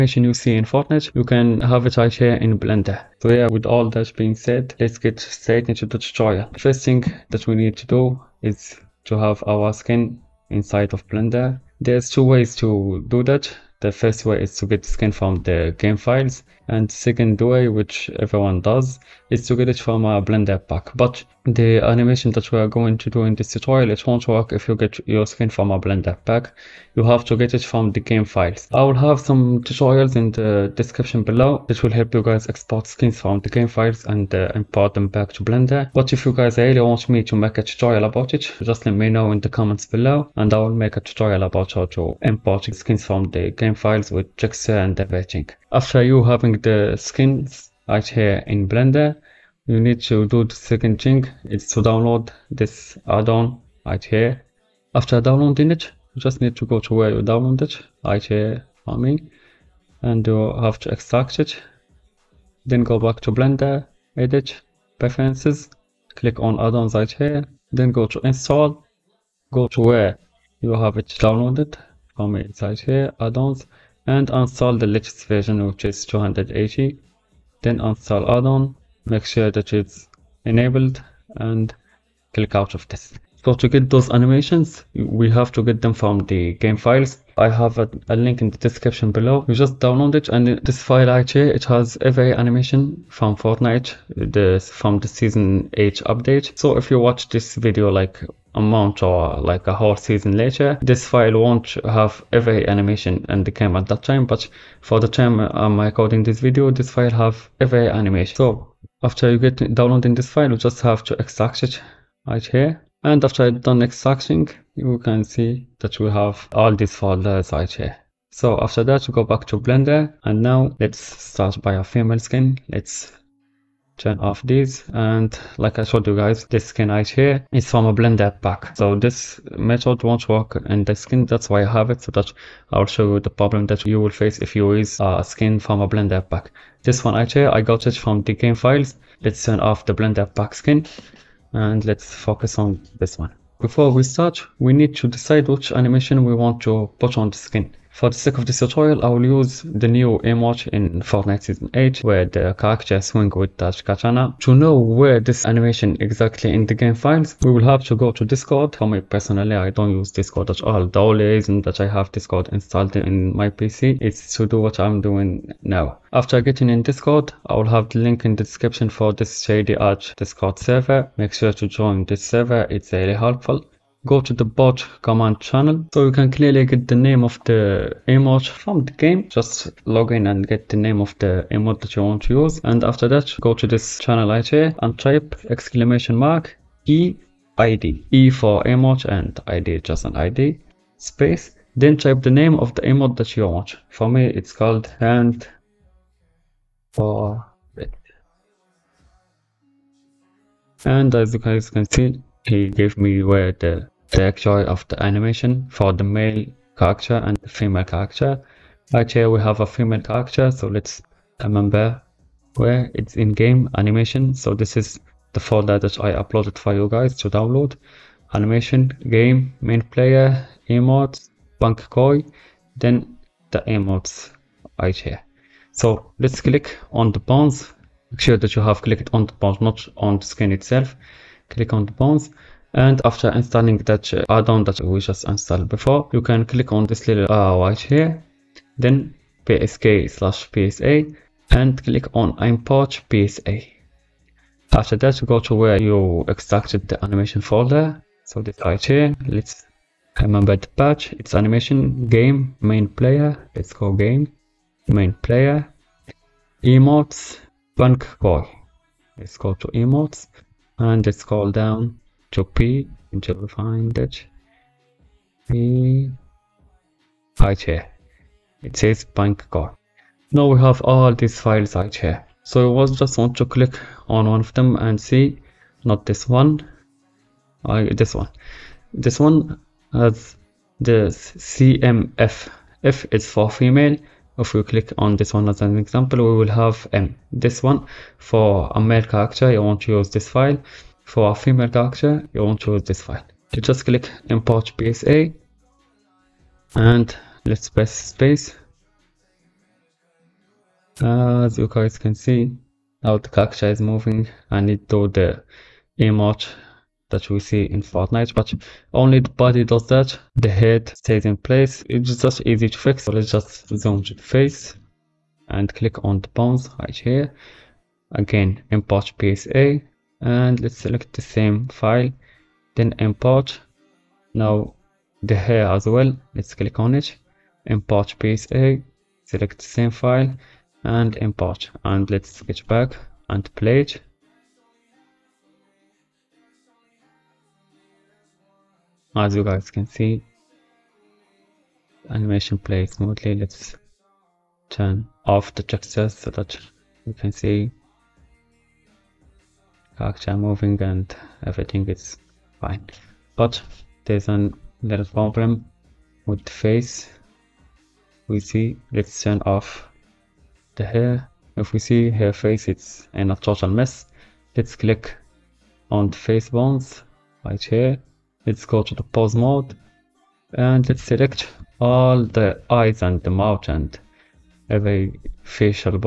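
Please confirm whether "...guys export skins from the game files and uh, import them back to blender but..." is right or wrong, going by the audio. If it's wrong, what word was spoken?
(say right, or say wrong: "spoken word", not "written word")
right.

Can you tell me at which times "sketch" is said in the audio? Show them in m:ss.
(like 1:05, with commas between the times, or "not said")
5:32.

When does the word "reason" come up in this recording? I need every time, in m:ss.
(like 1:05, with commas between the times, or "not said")
2:41.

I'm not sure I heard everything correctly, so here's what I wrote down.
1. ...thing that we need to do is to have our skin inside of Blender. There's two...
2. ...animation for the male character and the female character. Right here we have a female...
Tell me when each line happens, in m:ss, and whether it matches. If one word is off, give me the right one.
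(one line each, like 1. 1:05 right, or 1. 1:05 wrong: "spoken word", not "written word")
1. 0:06 right
2. 3:25 right.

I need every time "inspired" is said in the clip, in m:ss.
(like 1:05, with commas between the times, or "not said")
not said.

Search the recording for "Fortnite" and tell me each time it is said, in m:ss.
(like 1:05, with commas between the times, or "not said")
0:00, 1:33, 2:30, 5:07.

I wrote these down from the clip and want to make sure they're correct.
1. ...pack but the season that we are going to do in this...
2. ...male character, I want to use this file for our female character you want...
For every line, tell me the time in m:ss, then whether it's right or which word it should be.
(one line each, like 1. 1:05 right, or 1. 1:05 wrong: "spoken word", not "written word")
1. 0:20 wrong: "animation", not "season"
2. 4:48 right.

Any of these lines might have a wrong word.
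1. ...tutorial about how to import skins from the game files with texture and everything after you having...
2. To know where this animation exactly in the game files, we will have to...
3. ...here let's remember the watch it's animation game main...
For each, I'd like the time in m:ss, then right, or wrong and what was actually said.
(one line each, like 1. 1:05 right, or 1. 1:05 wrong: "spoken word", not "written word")
1. 0:40 right
2. 2:34 right
3. 4:08 wrong: "patch", not "watch".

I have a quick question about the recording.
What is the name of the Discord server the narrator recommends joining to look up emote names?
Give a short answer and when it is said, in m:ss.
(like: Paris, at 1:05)
Shady Arch, at 2:49.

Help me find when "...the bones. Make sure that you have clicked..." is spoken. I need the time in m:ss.
3:47.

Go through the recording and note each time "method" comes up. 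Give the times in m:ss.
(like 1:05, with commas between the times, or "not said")
2:09.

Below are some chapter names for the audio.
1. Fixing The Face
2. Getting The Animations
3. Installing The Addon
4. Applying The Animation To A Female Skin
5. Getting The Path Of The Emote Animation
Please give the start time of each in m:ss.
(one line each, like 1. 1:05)
1. 5:52
2. 1:22
3. 0:45
4. 3:45
5. 1:57.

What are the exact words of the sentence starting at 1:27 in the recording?
I have a, a link in the description below.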